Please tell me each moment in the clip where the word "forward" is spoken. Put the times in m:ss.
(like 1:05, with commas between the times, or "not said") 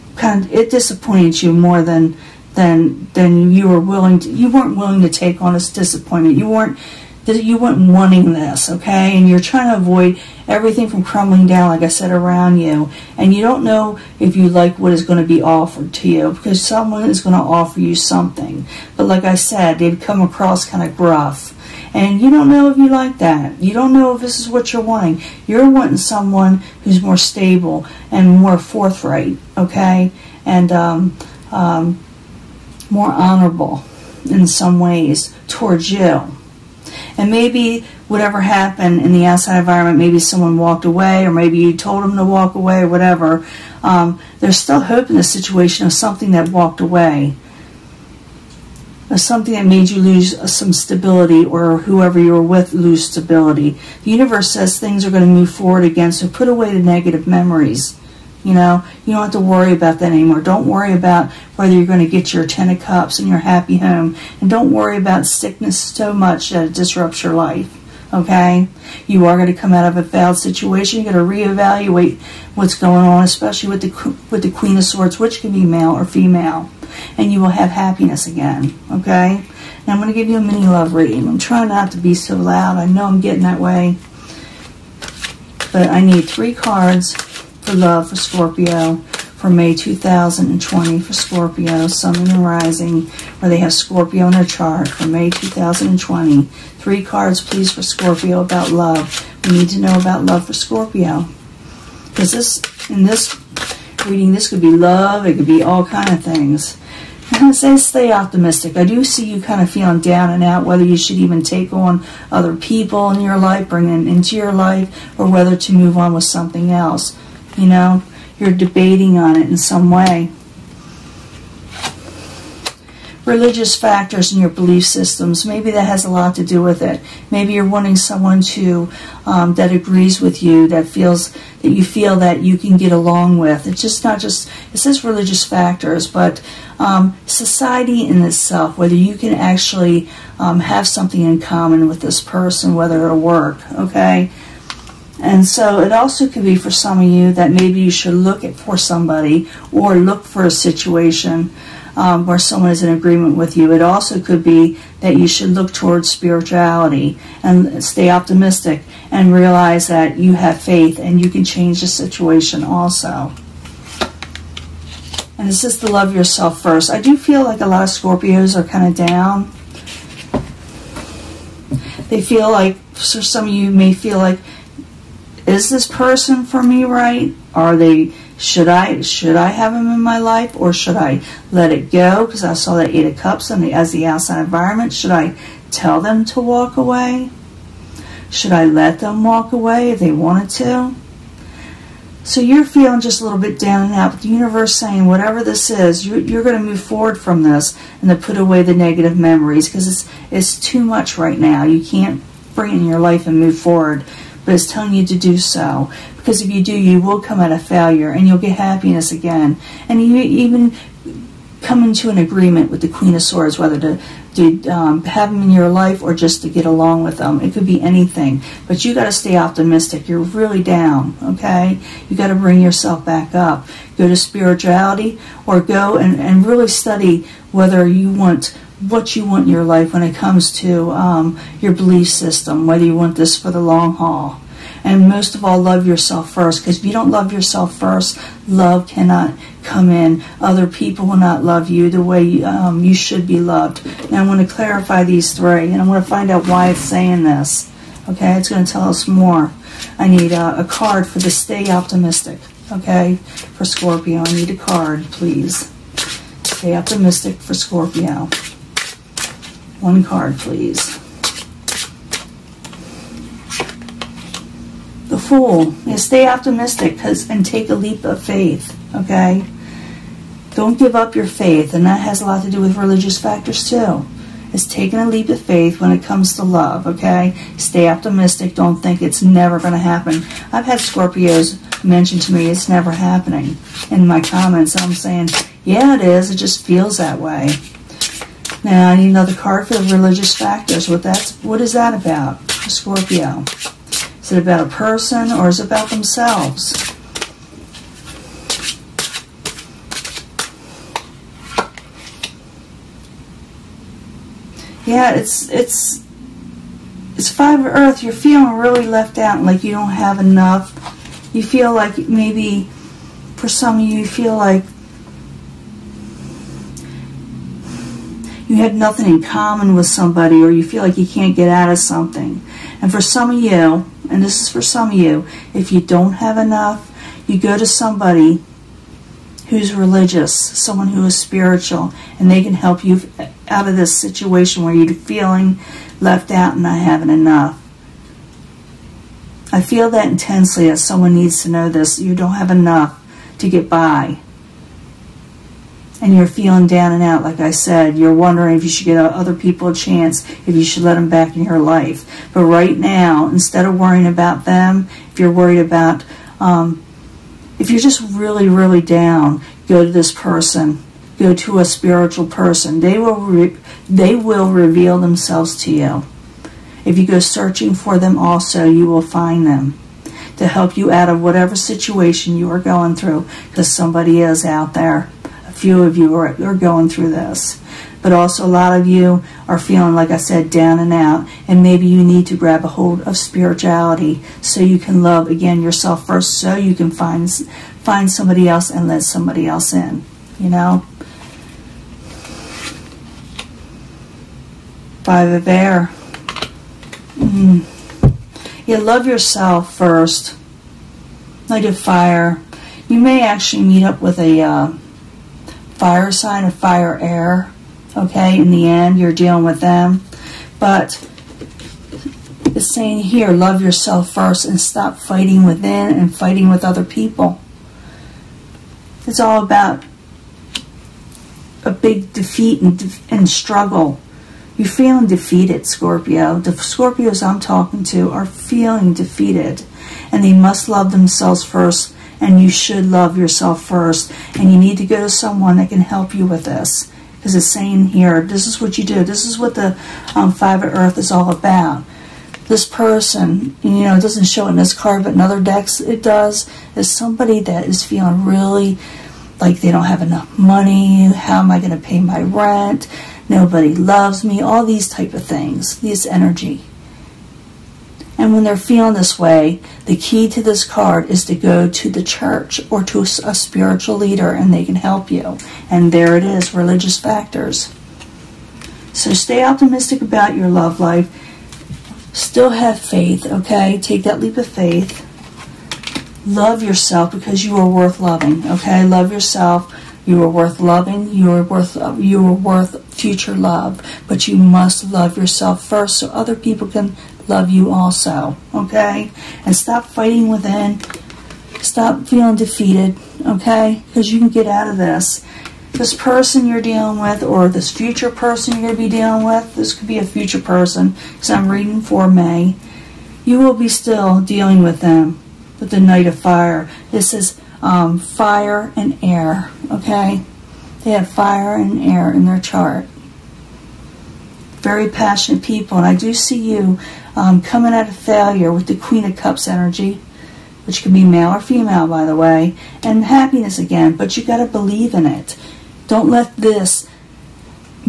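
0:55, 3:16, 3:23.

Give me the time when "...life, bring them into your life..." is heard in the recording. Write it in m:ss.
1:53.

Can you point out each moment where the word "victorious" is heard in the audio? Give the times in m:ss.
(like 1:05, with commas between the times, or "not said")
not said.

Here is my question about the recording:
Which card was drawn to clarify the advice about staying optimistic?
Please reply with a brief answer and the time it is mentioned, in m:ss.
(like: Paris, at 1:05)
The Fool, at 4:25.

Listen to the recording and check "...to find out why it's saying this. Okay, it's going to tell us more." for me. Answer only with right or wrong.
right.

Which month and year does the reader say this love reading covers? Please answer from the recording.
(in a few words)
May 2020.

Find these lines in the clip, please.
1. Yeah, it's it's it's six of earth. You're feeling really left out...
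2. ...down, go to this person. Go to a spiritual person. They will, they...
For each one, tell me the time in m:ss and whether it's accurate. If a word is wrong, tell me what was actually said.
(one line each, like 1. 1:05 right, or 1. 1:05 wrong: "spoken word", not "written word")
1. 5:04 wrong: "five", not "six"
2. 5:58 right.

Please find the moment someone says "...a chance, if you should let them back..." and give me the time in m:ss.
5:49.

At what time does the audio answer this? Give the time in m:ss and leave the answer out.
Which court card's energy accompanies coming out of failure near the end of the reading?
8:38.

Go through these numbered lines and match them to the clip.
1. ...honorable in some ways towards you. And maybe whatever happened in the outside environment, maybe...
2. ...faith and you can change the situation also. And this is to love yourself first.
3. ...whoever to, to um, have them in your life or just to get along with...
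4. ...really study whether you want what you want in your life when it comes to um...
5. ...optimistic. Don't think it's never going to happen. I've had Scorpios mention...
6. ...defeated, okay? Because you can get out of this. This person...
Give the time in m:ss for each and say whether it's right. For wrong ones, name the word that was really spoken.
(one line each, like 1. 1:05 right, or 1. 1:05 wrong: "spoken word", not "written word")
1. 0:33 right
2. 2:40 right
3. 3:33 wrong: "whether", not "whoever"
4. 3:46 right
5. 4:37 right
6. 8:12 right.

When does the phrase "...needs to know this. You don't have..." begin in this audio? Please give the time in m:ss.
5:41.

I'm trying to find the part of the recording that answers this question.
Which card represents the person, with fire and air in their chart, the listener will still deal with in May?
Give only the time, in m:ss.
8:25.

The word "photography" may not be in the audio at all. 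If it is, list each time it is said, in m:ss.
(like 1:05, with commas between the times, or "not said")
not said.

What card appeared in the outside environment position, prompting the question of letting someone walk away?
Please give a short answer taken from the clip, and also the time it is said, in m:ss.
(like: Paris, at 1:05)
Eight of Cups, at 3:02.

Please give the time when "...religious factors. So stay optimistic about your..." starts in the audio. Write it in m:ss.
7:46.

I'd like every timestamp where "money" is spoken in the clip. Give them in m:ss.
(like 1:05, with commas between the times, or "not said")
7:30.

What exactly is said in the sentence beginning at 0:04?
You weren't willing to take on this disappointment.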